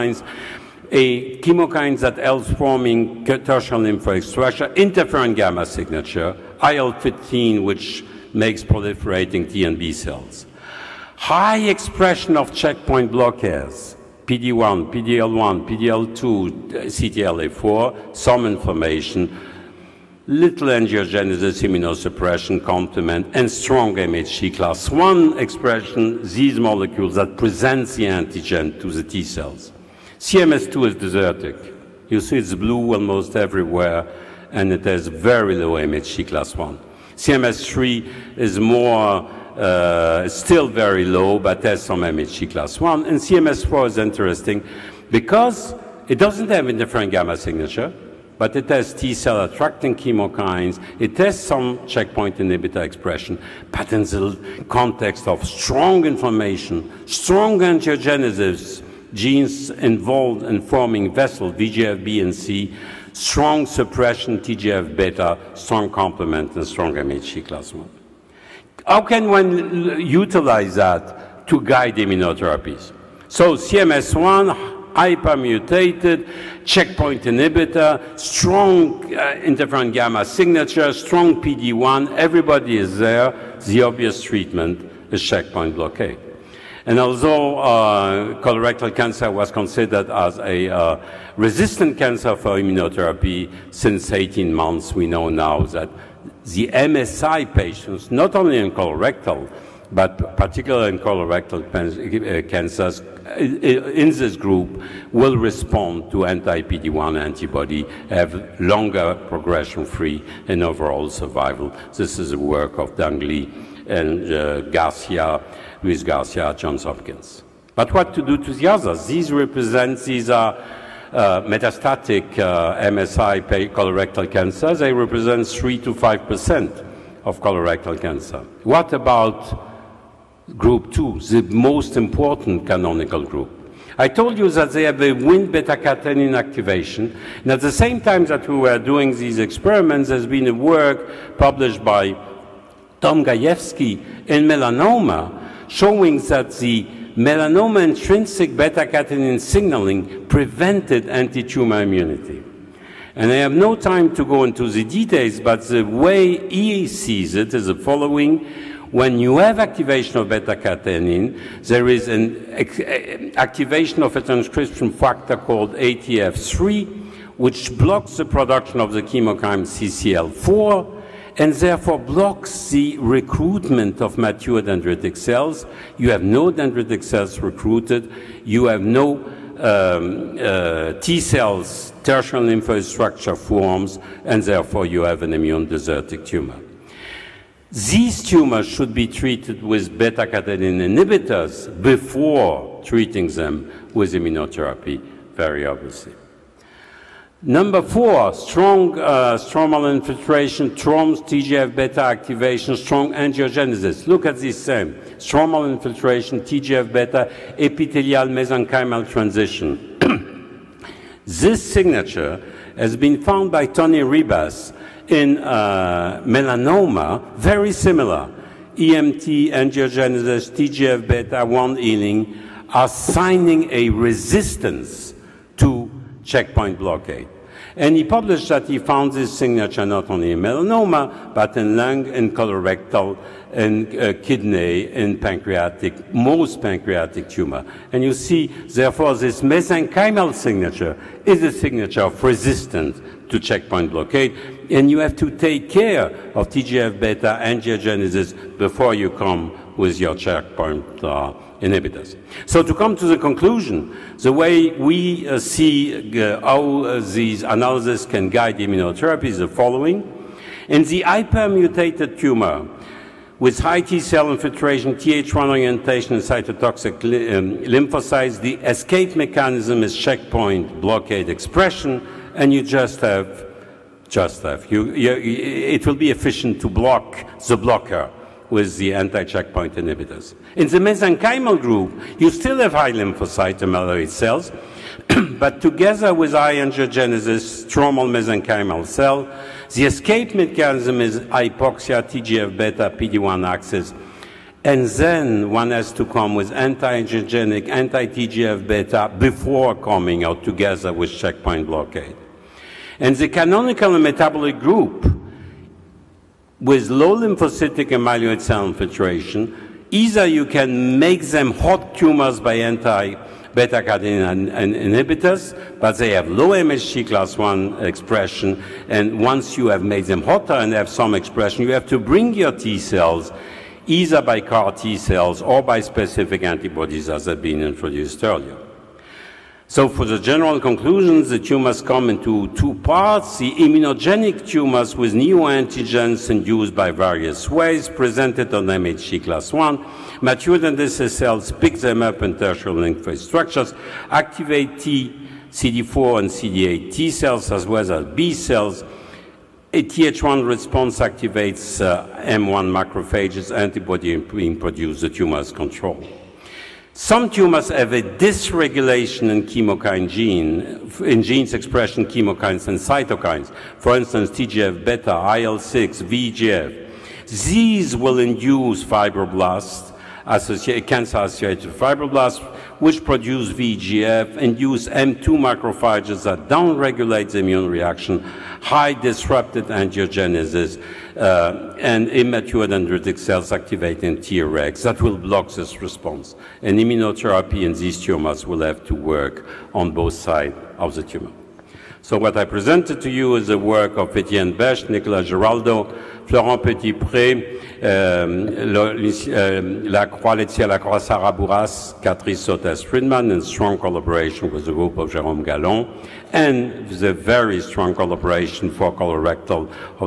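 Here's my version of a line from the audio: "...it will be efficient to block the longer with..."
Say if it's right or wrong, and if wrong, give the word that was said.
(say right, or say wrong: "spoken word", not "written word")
wrong: "blocker", not "longer".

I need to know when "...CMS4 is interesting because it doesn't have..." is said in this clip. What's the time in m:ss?
0:43.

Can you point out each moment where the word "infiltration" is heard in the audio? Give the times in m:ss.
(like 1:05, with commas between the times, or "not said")
3:19, 3:25, 4:24, 5:08.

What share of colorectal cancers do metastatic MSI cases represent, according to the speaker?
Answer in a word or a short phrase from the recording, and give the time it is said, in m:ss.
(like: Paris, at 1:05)
3 to 5 percent, at 2:05.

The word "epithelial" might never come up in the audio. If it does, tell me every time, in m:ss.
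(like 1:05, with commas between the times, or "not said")
3:27.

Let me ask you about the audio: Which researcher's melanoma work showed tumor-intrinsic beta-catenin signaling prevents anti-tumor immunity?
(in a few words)
Tom Gajewski.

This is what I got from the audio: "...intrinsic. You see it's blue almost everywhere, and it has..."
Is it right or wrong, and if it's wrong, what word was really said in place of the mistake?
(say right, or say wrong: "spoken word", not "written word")
wrong: "desertic", not "intrinsic".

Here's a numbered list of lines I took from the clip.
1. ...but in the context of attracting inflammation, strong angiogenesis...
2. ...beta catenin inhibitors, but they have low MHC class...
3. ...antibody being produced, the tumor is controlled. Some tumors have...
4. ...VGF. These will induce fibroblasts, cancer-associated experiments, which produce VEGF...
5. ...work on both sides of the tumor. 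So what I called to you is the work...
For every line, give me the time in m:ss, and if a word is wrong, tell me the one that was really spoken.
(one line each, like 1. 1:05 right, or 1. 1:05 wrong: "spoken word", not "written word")
1. 0:53 wrong: "strong", not "attracting"
2. 5:13 right
3. 5:53 right
4. 6:06 wrong: "fibroblasts", not "experiments"
5. 6:28 wrong: "presented", not "called".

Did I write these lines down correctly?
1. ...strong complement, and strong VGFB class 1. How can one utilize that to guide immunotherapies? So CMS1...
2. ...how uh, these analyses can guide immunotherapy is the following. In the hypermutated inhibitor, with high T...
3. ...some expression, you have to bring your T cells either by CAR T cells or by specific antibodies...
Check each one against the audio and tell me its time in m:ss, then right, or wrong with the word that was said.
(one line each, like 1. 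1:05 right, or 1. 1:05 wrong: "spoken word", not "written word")
1. 1:05 wrong: "MHC", not "VGFB"
2. 4:16 wrong: "tumor", not "inhibitor"
3. 5:20 right.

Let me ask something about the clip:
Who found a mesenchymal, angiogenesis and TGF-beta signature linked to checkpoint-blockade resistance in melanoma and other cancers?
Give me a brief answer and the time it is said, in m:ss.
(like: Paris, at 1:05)
Tony Ribas, at 3:33.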